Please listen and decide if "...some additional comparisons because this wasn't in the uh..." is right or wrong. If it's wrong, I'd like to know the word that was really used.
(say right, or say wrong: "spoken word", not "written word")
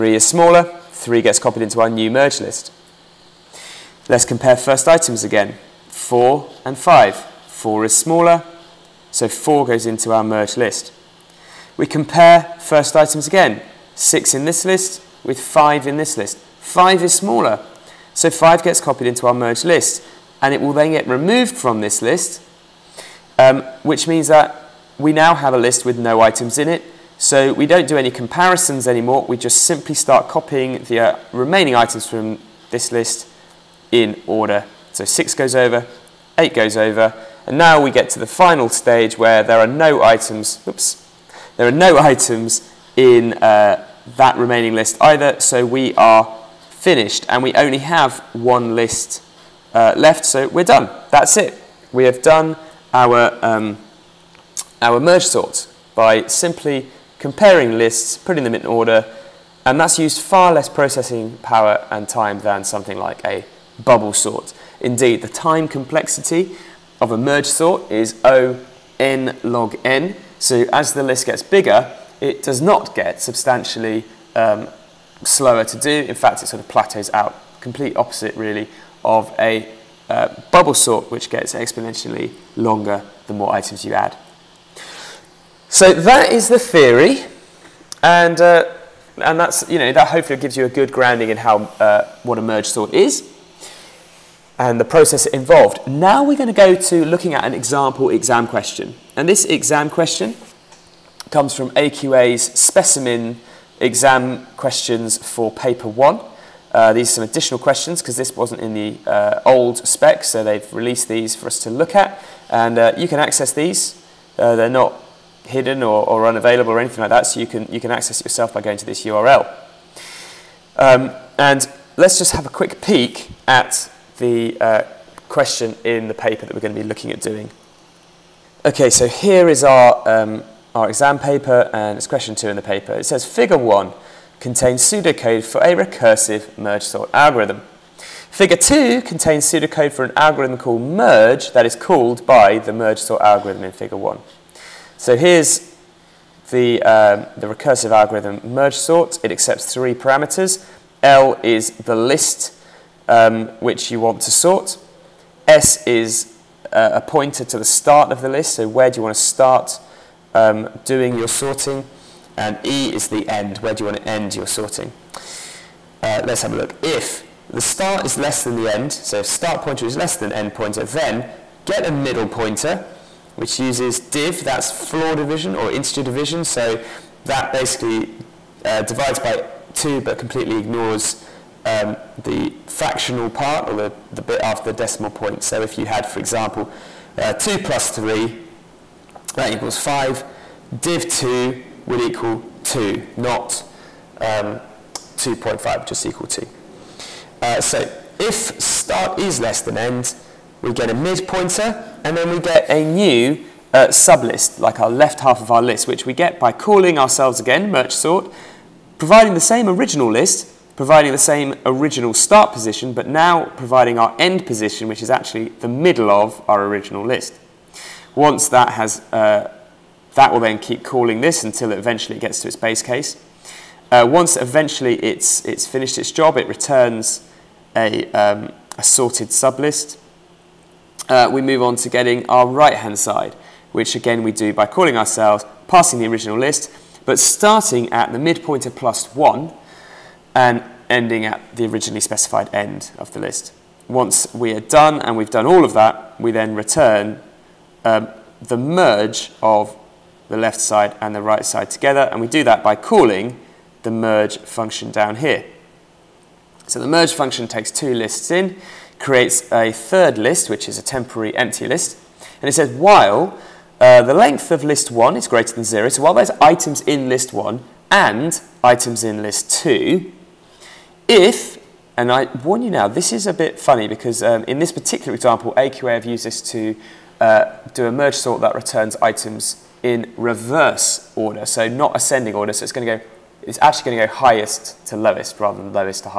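wrong: "questions", not "comparisons".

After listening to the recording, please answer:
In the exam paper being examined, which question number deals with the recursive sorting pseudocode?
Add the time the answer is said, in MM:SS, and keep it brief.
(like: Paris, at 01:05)
2, at 02:12.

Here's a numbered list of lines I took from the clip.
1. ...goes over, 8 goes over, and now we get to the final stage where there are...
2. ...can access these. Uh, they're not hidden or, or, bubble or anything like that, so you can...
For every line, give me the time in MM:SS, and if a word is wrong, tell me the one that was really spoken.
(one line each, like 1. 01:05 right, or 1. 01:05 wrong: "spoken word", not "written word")
1. 00:35 right
2. 01:53 wrong: "unavailable", not "bubble".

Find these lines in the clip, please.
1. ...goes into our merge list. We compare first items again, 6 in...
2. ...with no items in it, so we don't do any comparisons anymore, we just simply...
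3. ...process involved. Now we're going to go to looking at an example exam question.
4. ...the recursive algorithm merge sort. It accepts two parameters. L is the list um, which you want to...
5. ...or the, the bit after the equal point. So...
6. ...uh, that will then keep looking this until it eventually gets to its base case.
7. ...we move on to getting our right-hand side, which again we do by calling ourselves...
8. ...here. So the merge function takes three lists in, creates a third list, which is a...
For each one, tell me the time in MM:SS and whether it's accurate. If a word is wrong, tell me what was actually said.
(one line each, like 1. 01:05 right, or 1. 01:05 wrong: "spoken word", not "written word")
1. 00:09 right
2. 00:25 right
3. 01:34 right
4. 02:27 wrong: "three", not "two"
5. 03:03 wrong: "decimal", not "equal"
6. 03:39 wrong: "calling", not "looking"
7. 03:51 right
8. 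04:15 wrong: "two", not "three".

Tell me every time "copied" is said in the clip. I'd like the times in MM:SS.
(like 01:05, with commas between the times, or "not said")
00:01, 00:18.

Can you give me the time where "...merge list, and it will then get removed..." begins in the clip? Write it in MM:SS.
00:19.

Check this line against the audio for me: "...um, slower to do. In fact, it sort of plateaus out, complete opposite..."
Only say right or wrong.
right.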